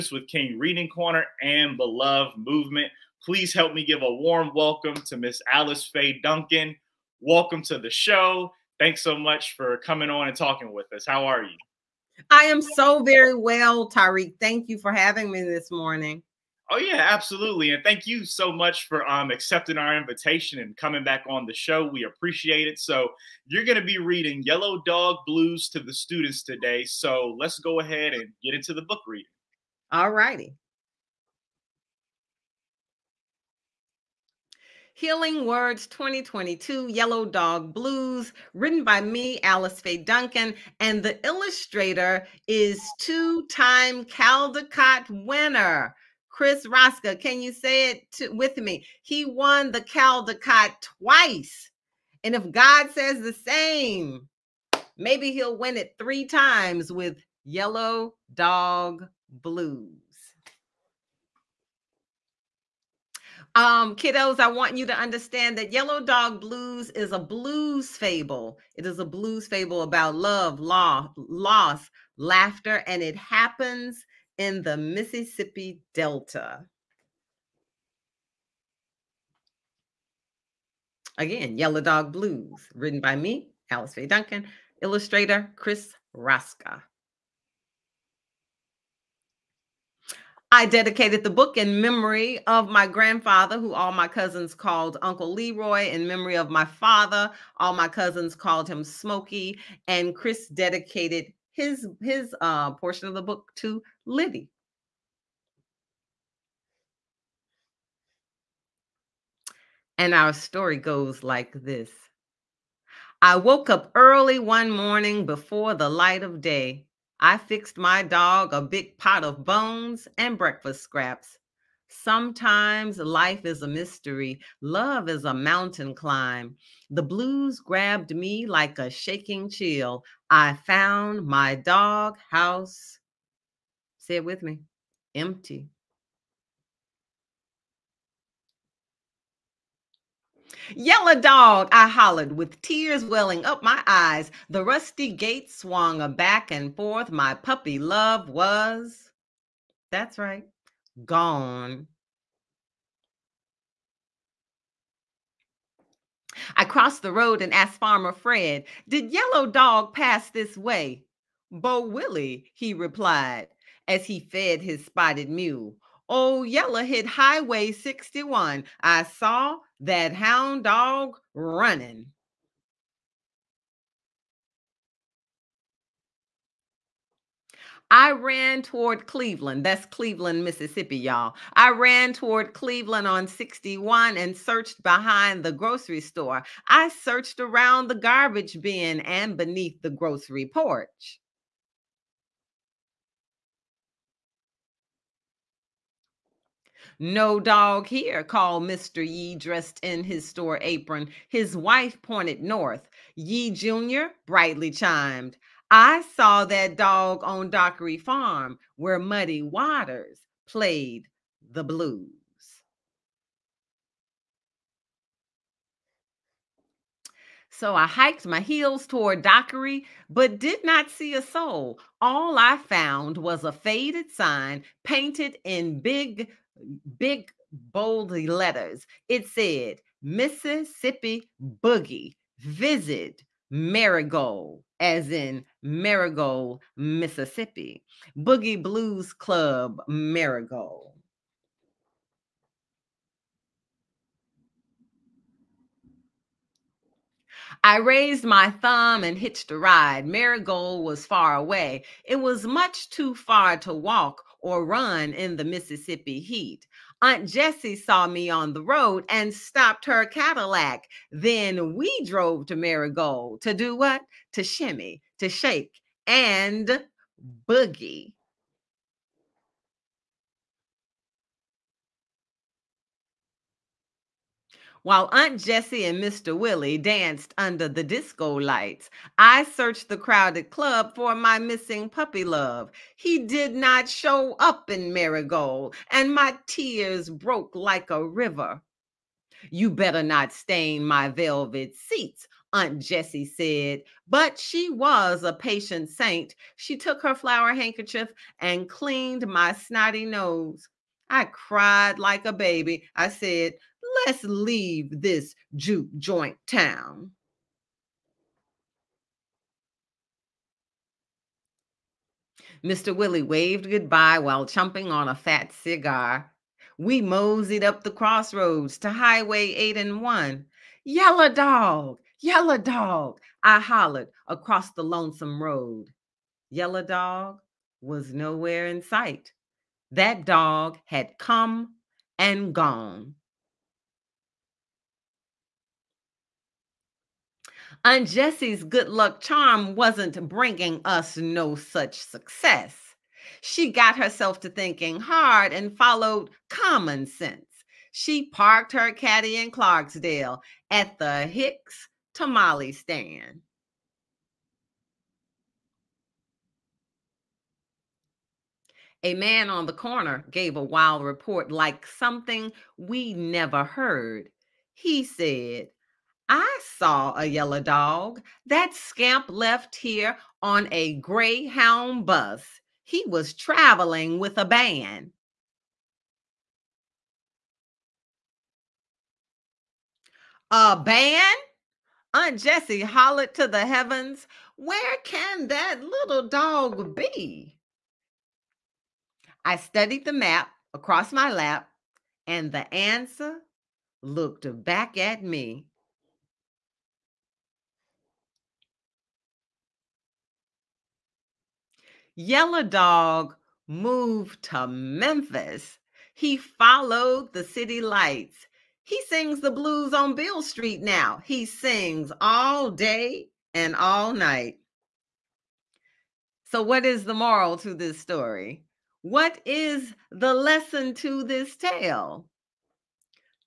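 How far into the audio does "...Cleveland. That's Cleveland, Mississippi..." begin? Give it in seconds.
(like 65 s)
179 s.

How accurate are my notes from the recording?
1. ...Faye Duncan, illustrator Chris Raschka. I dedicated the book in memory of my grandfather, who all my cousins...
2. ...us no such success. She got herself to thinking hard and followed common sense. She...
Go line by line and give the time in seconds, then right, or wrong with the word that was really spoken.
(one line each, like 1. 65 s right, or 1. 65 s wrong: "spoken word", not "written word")
1. 83 s right
2. 340 s right.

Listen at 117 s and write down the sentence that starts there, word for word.
I fixed my dog a big pot of bones and breakfast scraps.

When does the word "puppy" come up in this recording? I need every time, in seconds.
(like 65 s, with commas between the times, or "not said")
147 s, 281 s.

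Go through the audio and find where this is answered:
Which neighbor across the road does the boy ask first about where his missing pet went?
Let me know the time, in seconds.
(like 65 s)
157 s.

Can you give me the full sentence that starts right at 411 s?
He sings all day and all night.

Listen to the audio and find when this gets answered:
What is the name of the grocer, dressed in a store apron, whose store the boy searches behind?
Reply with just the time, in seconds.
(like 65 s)
198 s.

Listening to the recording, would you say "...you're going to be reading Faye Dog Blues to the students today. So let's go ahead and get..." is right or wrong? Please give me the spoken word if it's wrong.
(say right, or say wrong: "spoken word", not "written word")
wrong: "Yellow", not "Faye".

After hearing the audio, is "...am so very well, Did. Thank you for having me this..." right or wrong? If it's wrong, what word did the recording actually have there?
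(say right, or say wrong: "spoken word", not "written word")
wrong: "Tariq", not "Did".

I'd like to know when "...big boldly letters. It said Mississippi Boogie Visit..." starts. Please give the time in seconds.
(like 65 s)
226 s.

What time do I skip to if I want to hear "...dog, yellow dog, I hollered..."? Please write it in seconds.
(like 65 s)
321 s.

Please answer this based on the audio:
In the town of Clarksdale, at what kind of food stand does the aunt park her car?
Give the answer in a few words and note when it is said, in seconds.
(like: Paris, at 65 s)
Hicks tamale stand, at 351 s.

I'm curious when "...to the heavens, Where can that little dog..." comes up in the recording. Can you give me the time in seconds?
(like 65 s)
383 s.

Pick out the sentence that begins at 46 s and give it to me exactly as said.
Chris Raschka, can you say it to, with me?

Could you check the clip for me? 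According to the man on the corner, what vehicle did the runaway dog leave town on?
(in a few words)
Greyhound bus.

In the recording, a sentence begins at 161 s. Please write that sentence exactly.
Bo Willie, he replied, as he fed his spotted mule old oh, Yeller hit Highway 61.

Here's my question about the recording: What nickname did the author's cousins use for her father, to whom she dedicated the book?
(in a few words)
Smokey.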